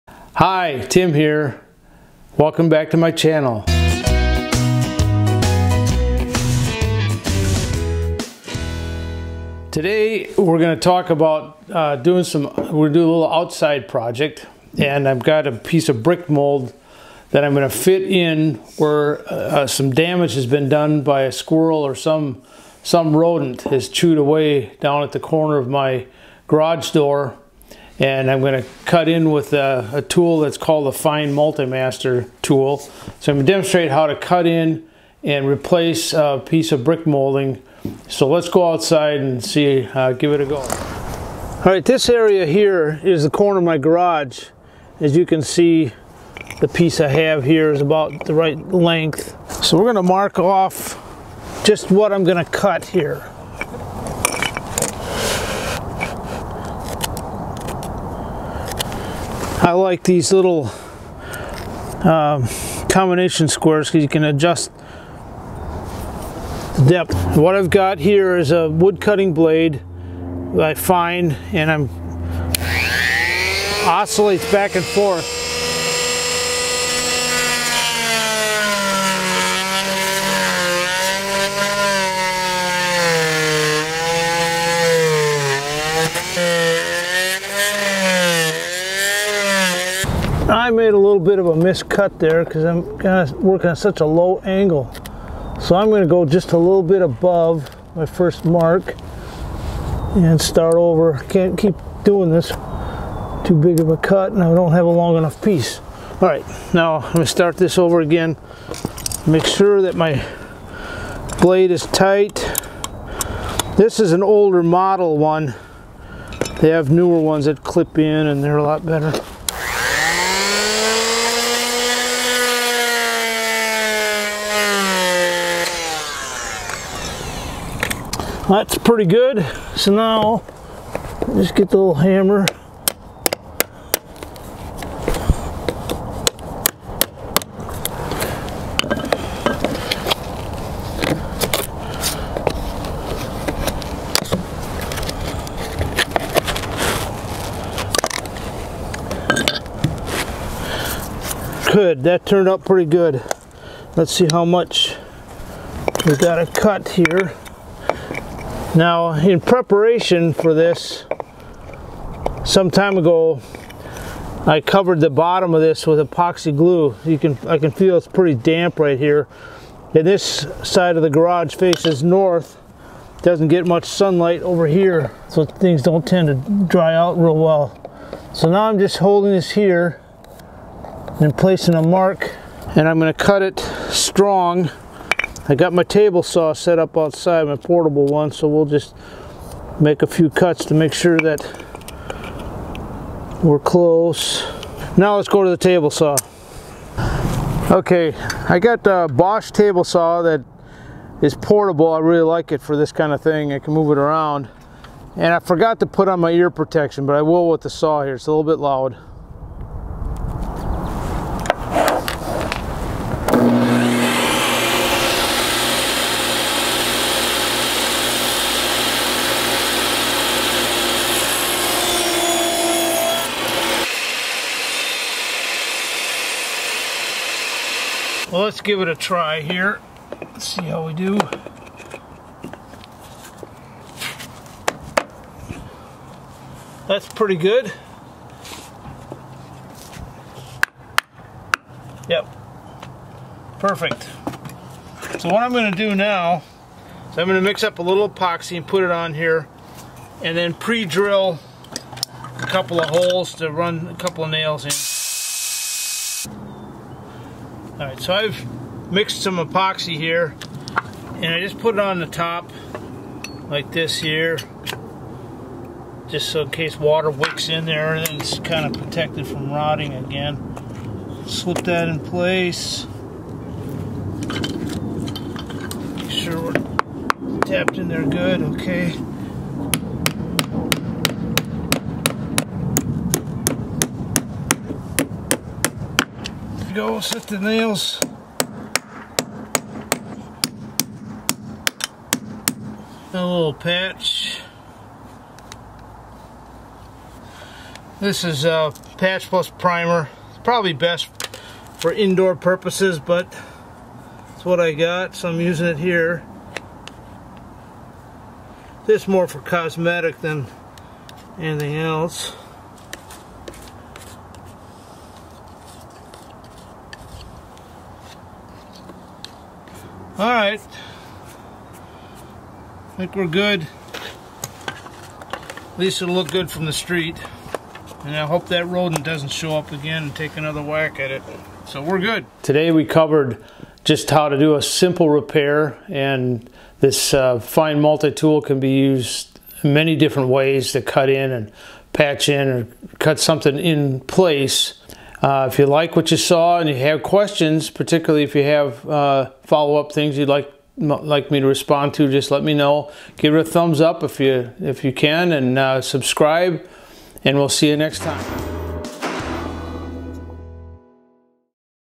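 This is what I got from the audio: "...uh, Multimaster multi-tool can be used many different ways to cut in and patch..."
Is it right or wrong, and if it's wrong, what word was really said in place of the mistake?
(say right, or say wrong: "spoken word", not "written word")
wrong: "Fein", not "Multimaster".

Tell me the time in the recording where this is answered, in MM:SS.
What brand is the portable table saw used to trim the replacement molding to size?
03:19.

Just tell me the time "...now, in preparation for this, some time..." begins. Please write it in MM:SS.
02:38.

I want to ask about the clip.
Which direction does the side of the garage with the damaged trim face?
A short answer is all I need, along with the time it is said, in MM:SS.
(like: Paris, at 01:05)
North, at 02:52.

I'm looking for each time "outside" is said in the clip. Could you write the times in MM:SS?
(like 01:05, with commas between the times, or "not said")
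00:13, 00:38, 03:06.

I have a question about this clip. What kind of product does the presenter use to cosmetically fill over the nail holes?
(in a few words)
Patch plus primer.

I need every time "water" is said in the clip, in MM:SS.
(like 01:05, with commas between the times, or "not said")
04:26.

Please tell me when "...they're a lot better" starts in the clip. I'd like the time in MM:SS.
01:58.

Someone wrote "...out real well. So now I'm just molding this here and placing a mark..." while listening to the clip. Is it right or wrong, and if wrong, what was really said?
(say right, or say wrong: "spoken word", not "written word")
wrong: "holding", not "molding".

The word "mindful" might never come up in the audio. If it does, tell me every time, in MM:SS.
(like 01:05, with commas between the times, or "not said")
not said.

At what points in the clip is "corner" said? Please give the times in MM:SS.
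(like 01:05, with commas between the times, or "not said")
00:25, 00:43.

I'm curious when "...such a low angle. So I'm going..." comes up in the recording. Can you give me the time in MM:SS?
01:33.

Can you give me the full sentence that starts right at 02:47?
You can, I can feel it's pretty damp right here.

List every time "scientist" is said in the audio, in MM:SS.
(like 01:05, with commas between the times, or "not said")
not said.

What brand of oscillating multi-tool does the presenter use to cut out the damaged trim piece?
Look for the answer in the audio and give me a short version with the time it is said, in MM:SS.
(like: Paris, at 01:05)
Fein Multimaster, at 00:30.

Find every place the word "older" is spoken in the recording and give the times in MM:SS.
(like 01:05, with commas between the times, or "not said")
01:54.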